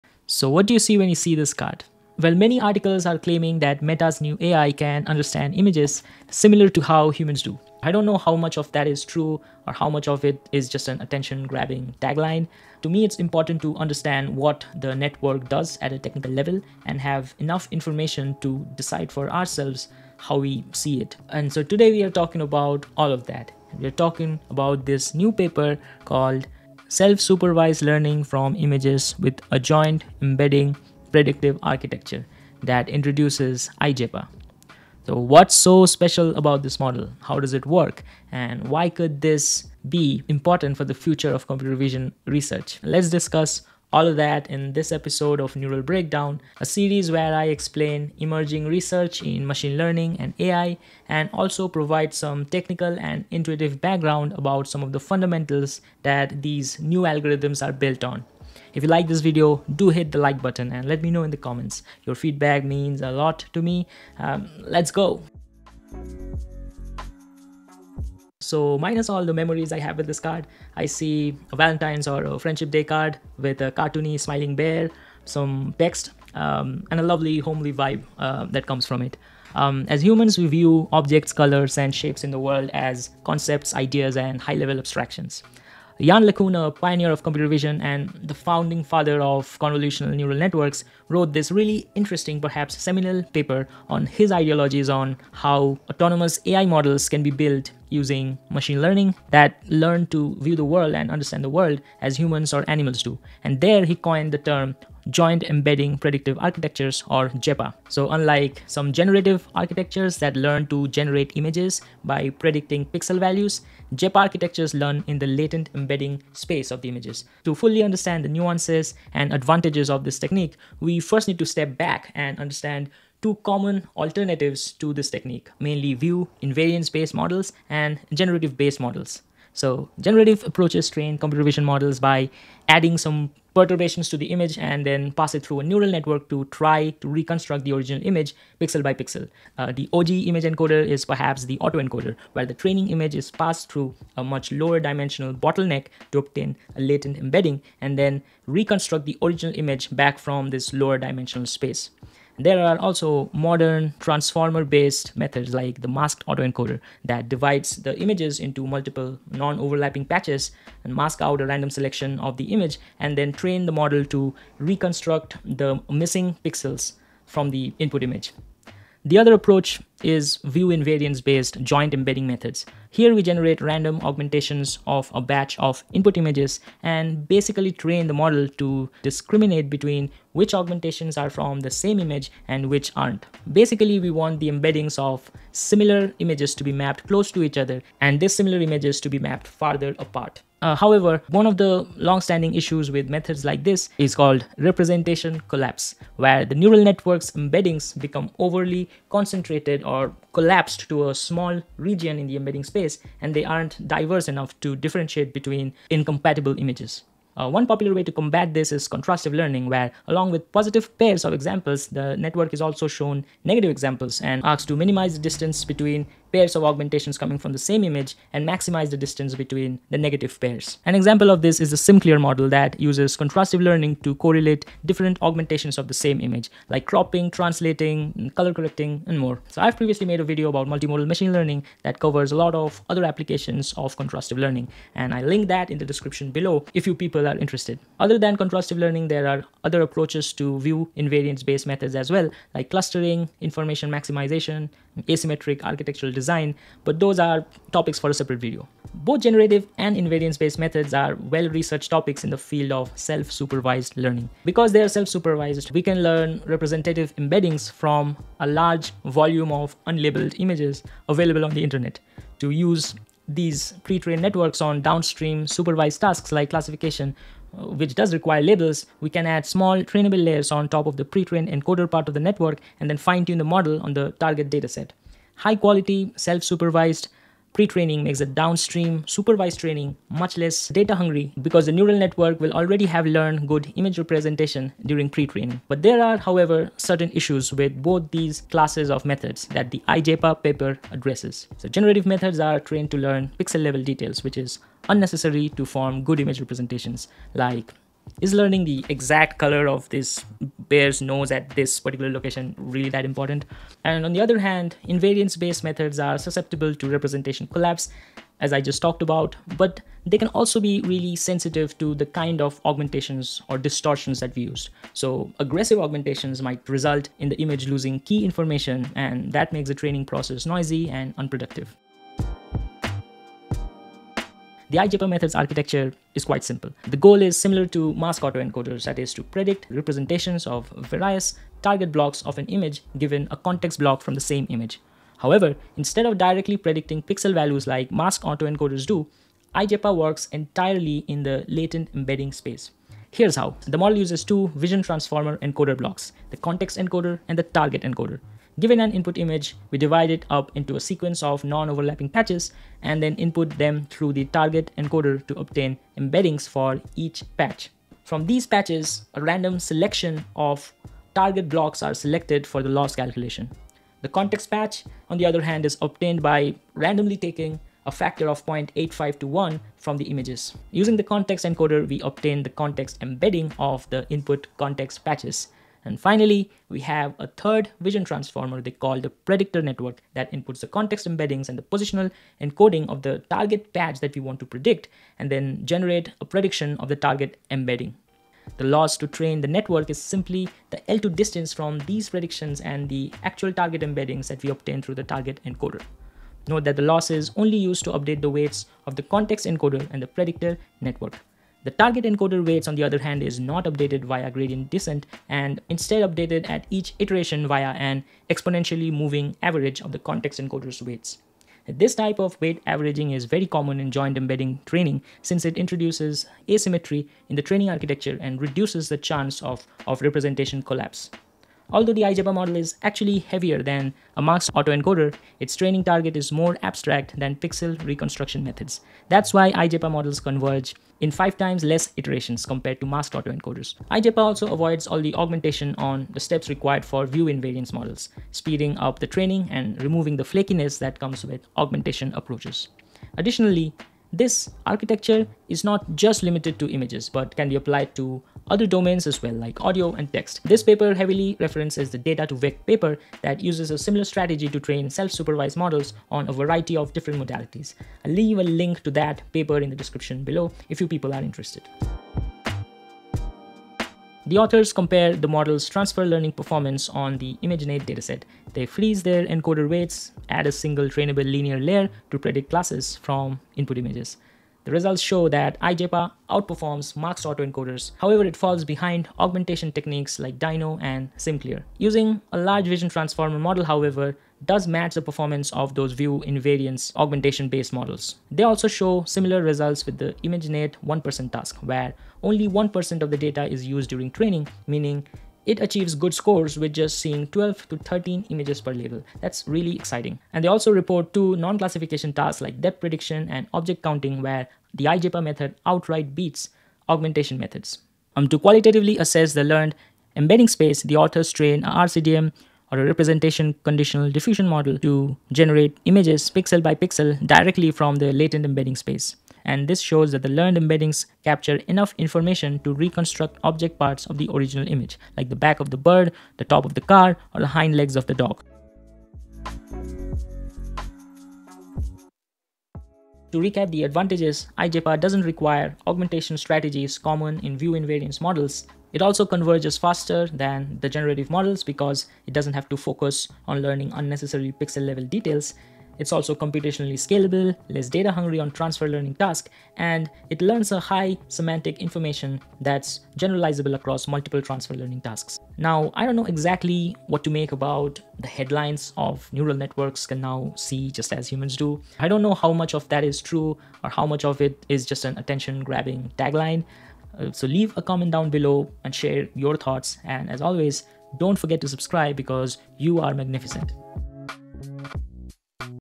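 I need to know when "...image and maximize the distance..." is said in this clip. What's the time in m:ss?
3:37.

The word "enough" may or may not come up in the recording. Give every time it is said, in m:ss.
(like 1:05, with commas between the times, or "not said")
0:17, 3:24, 8:41.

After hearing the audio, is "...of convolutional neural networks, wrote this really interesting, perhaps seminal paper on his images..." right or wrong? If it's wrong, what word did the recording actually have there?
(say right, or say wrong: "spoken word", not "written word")
wrong: "ideologies", not "images".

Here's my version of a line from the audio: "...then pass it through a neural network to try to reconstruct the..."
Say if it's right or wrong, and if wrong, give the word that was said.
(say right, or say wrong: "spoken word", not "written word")
right.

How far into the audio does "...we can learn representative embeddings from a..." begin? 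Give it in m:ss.
4:15.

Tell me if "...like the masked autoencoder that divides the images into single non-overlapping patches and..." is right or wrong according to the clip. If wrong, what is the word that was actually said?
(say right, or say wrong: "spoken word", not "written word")
wrong: "multiple", not "single".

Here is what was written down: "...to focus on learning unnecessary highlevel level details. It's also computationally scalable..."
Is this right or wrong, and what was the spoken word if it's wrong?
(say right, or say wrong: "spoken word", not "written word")
wrong: "pixel", not "highlevel".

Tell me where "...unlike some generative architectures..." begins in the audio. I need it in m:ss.
1:48.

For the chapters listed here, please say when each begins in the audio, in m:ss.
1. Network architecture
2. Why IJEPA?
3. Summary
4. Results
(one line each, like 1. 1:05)
1. 5:22
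2. 1:05
3. 8:50
4. 7:43.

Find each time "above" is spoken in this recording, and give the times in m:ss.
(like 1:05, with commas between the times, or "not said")
not said.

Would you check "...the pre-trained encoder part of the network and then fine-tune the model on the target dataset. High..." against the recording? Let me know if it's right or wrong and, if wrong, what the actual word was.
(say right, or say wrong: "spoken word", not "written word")
right.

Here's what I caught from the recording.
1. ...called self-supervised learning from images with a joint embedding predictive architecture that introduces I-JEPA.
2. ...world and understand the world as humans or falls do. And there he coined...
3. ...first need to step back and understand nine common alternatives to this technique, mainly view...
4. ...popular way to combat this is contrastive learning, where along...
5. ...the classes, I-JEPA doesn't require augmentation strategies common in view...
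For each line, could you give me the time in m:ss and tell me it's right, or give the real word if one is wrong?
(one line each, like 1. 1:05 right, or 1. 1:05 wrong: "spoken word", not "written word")
1. 0:26 right
2. 1:40 wrong: "animals", not "falls"
3. 2:00 wrong: "two", not "nine"
4. 3:27 right
5. 8:53 wrong: "advantages", not "classes".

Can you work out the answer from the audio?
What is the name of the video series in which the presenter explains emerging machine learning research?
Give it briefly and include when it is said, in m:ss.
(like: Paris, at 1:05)
Neural Breakdown, at 0:45.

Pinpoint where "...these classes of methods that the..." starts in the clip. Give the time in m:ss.
4:48.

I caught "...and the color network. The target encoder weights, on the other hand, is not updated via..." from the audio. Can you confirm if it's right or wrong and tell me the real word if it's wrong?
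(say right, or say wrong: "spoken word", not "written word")
wrong: "predictor", not "color".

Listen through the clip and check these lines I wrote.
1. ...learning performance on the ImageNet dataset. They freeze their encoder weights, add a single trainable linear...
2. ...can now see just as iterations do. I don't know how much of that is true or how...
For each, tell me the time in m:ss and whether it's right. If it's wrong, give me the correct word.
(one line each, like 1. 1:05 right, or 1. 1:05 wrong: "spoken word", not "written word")
1. 7:46 right
2. 9:20 wrong: "humans", not "iterations".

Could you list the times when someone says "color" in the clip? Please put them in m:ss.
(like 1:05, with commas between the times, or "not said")
1:21, 3:48, 4:59.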